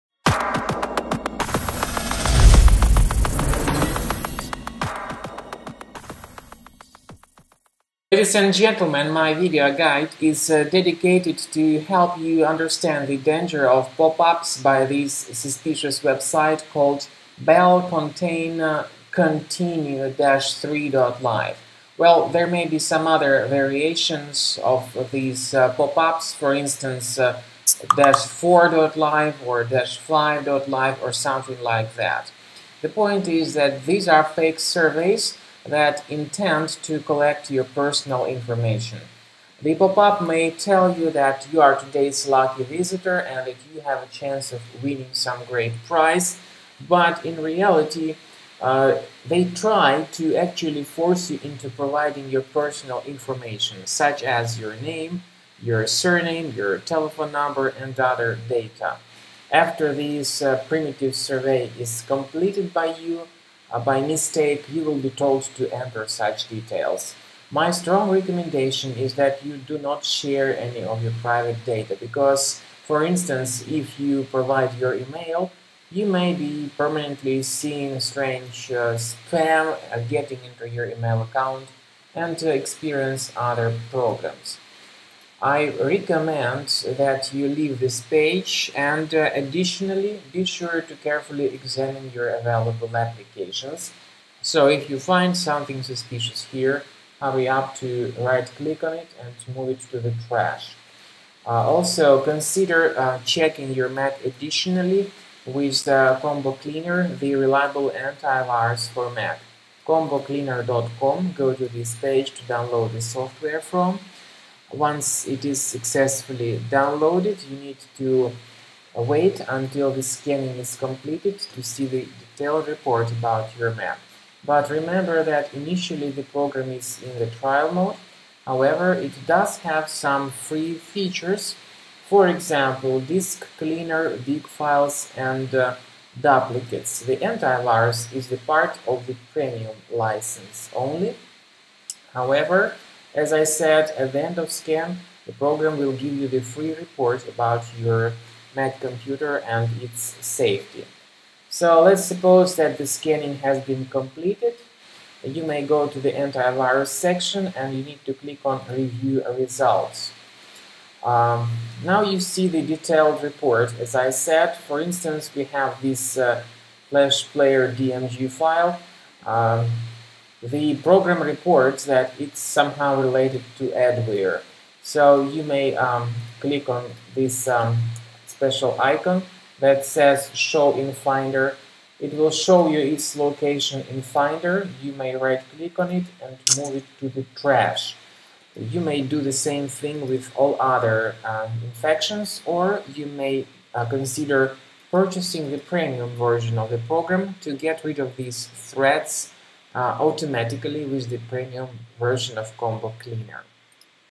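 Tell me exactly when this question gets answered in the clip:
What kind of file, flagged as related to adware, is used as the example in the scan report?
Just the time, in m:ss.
2:46.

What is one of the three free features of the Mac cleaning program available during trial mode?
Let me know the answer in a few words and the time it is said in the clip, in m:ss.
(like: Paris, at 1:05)
disk cleaner, at 2:13.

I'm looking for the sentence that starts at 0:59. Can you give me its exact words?
After this uh, primitive survey is completed by you, uh, by mistake, you will be told to enter such details.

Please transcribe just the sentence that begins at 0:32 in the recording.
The point is that these are fake surveys that intend to collect your personal information.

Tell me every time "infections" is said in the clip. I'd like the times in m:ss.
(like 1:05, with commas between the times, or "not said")
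3:11.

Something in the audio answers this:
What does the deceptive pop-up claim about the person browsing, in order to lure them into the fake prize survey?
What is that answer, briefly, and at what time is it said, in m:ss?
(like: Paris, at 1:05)
today's lucky visitor, at 0:41.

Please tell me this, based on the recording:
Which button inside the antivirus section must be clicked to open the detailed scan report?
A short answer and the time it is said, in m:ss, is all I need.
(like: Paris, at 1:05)
review results, at 2:38.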